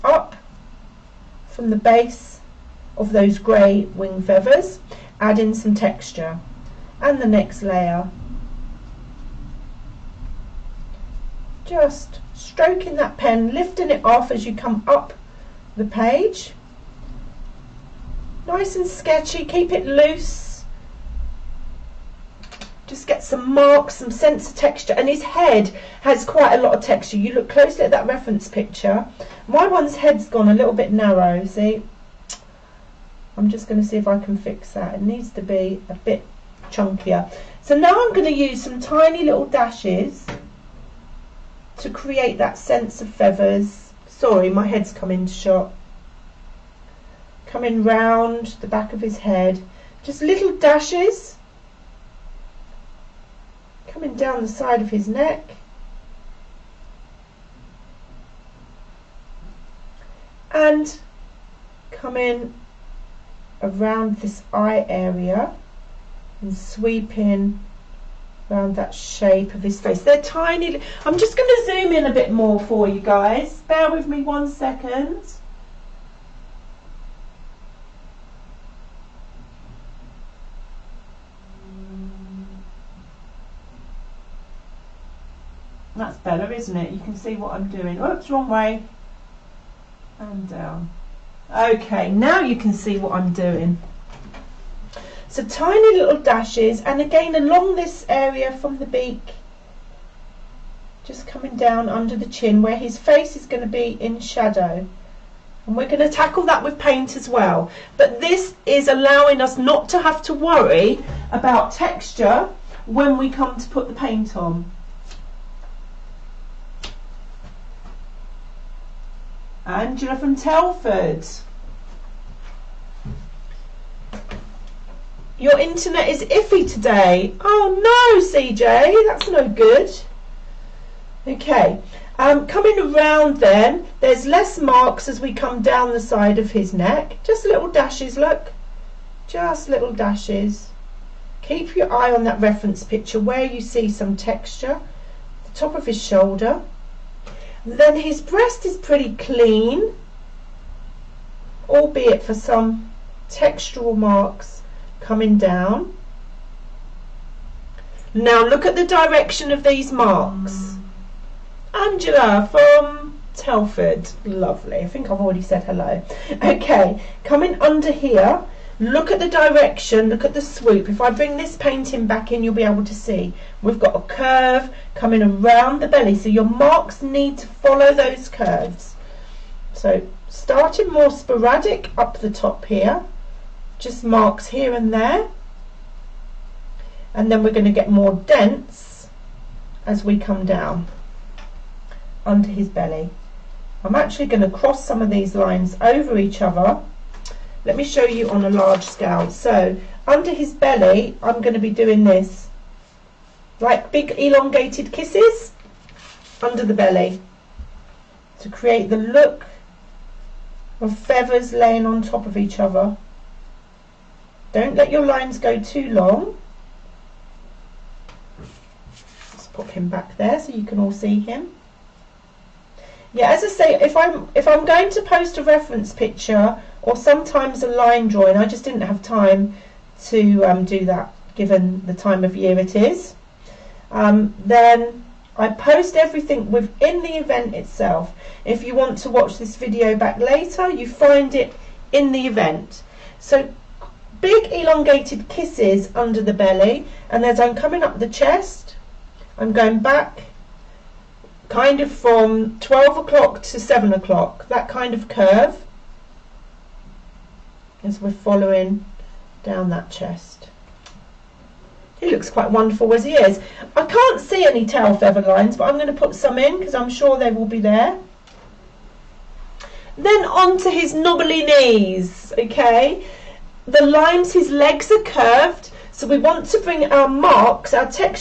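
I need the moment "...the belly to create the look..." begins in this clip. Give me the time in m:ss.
3:26.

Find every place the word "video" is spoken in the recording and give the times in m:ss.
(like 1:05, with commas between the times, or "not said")
3:59.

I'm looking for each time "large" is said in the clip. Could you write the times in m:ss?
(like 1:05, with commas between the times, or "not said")
3:18.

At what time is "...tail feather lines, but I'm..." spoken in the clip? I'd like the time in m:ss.
4:24.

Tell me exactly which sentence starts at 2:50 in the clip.
If I bring this painting back in, you'll be able to see.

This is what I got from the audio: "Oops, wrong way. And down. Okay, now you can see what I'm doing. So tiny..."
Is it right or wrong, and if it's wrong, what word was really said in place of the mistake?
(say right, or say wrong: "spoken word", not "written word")
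right.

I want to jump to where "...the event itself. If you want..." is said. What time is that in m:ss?
3:57.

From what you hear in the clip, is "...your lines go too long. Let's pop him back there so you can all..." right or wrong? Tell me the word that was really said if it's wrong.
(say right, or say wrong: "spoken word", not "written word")
right.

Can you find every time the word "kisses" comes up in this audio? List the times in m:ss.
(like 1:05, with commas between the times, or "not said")
3:24, 4:05.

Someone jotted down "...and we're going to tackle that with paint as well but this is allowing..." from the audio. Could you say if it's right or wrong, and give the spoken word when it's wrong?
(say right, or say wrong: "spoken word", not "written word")
right.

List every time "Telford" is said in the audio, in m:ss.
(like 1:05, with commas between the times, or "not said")
2:00, 2:43.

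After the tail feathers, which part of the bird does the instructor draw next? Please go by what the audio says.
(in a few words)
knobbly knees.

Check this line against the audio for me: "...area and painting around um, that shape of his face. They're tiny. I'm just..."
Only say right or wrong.
wrong.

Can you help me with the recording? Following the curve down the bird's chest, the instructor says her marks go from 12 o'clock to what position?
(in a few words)
7 o'clock.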